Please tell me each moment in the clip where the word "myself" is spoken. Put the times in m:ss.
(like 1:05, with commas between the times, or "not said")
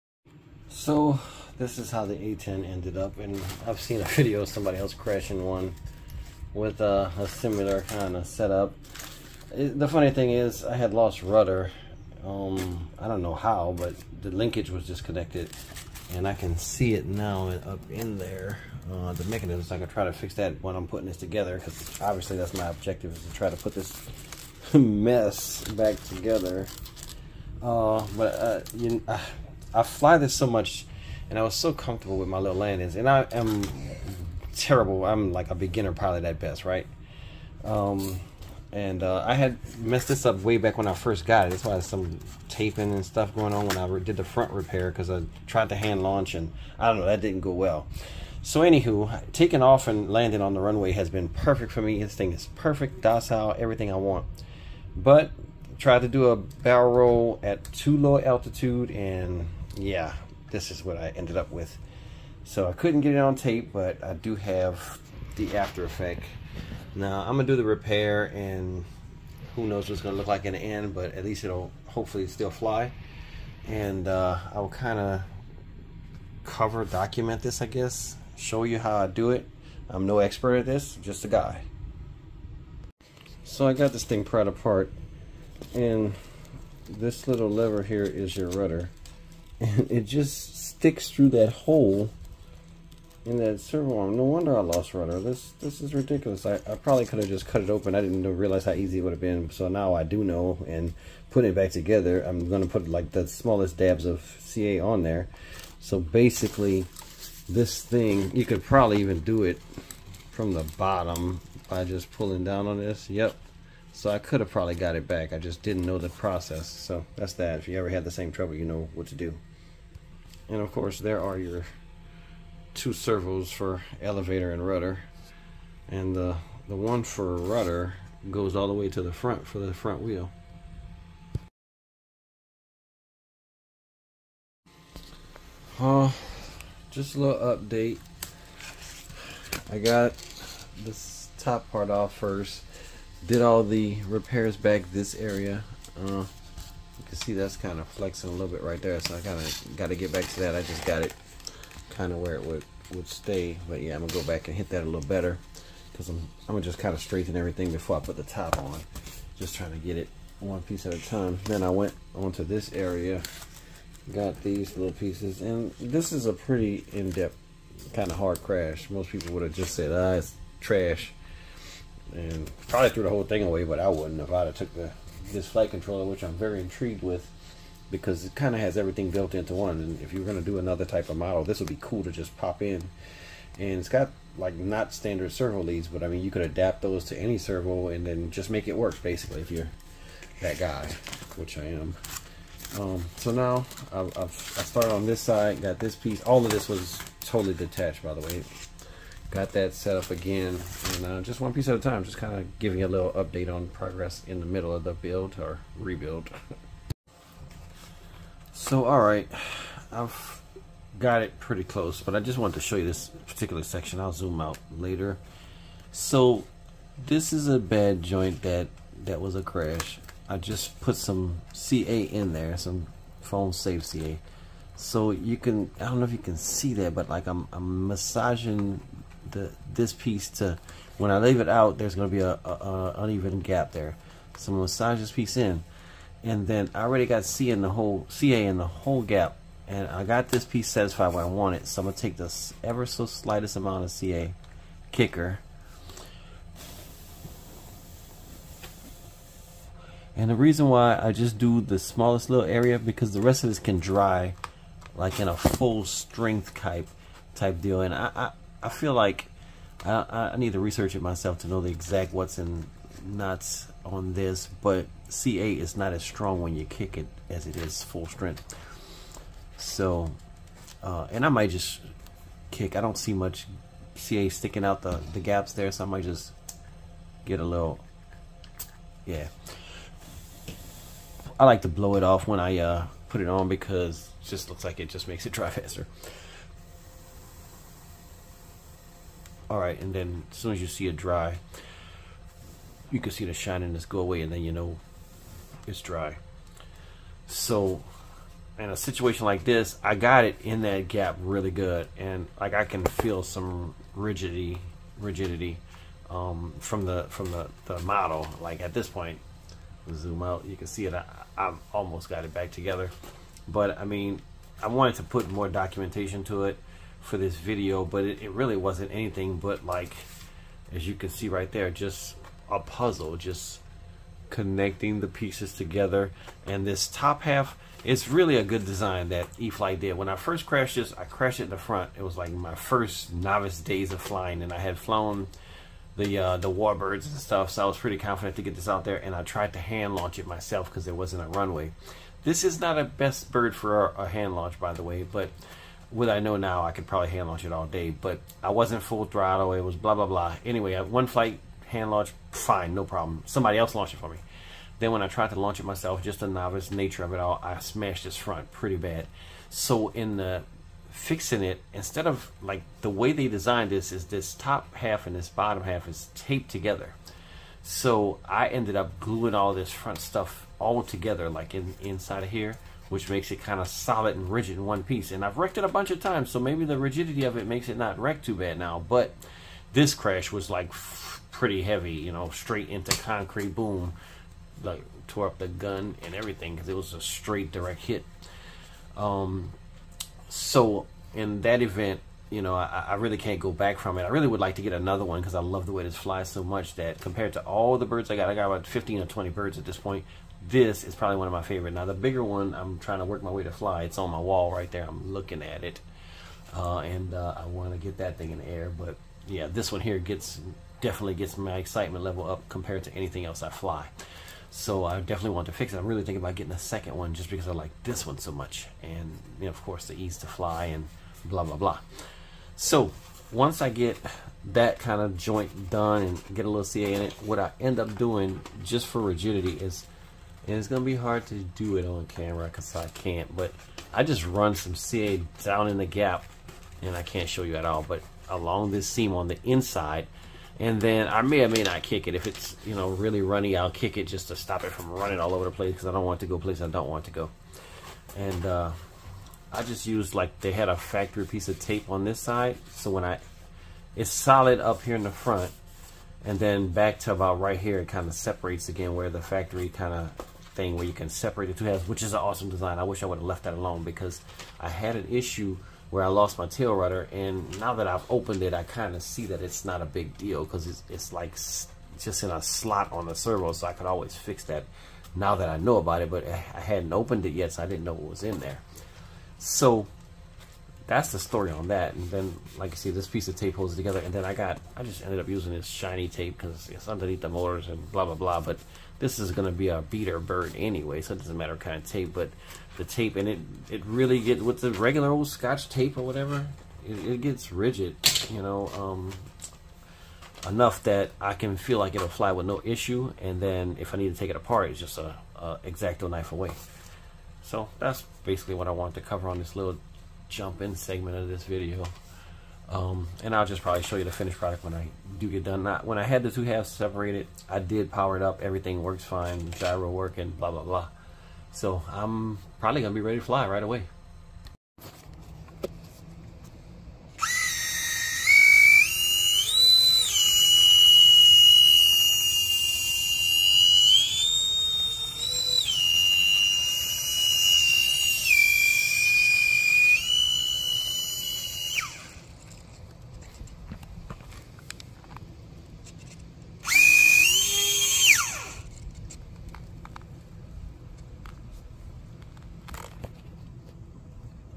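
4:21, 5:40, 5:55.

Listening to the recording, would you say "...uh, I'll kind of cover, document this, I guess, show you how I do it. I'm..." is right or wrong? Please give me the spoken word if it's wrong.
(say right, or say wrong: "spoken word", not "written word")
right.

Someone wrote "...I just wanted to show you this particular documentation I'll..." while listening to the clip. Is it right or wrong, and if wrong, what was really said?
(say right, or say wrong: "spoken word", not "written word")
wrong: "section", not "documentation".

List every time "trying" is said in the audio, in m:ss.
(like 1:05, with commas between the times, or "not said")
2:39, 6:42.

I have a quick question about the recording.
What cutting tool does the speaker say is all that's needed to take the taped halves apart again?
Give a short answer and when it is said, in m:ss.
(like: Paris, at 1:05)
X-Acto knife, at 8:25.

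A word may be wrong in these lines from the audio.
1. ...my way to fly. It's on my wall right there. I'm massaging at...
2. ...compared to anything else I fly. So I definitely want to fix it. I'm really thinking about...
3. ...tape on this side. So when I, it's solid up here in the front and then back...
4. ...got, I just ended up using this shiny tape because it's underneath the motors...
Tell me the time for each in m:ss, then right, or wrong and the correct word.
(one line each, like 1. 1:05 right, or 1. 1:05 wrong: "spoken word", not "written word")
1. 6:43 wrong: "looking", not "massaging"
2. 6:52 right
3. 7:31 right
4. 8:04 right.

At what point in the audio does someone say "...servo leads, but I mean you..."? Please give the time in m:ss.
3:05.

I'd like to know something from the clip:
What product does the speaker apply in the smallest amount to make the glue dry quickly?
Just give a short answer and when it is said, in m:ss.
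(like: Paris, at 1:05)
CA kicker, at 4:03.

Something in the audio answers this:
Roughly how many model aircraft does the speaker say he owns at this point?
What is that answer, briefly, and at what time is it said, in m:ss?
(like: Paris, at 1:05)
15 or 20, at 6:38.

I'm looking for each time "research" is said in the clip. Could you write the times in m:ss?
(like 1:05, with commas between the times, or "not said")
4:20.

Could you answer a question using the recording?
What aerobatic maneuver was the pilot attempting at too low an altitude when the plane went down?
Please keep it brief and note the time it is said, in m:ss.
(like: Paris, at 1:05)
Barrel roll, at 0:56.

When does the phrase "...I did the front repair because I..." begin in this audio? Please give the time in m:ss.
0:43.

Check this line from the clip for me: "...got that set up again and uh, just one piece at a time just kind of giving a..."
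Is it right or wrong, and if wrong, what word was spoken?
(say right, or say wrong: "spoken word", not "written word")
right.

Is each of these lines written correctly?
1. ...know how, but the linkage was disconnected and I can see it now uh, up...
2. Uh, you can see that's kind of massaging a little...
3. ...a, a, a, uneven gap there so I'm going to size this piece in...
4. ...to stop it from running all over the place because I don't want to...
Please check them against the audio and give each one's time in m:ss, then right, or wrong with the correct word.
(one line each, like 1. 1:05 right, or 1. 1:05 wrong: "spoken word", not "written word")
1. 0:13 right
2. 2:26 wrong: "flexing", not "massaging"
3. 3:52 right
4. 7:24 right.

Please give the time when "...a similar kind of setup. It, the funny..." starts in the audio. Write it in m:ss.
0:07.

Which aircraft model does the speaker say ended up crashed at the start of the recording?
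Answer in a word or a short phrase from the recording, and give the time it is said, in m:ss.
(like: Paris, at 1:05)
A10, at 0:02.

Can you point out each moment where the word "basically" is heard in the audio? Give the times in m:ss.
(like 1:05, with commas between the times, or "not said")
1:45, 3:09, 8:28.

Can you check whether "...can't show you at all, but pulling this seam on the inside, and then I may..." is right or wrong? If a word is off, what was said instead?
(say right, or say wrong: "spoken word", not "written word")
wrong: "along", not "pulling".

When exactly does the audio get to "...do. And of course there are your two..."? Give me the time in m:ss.
1:59.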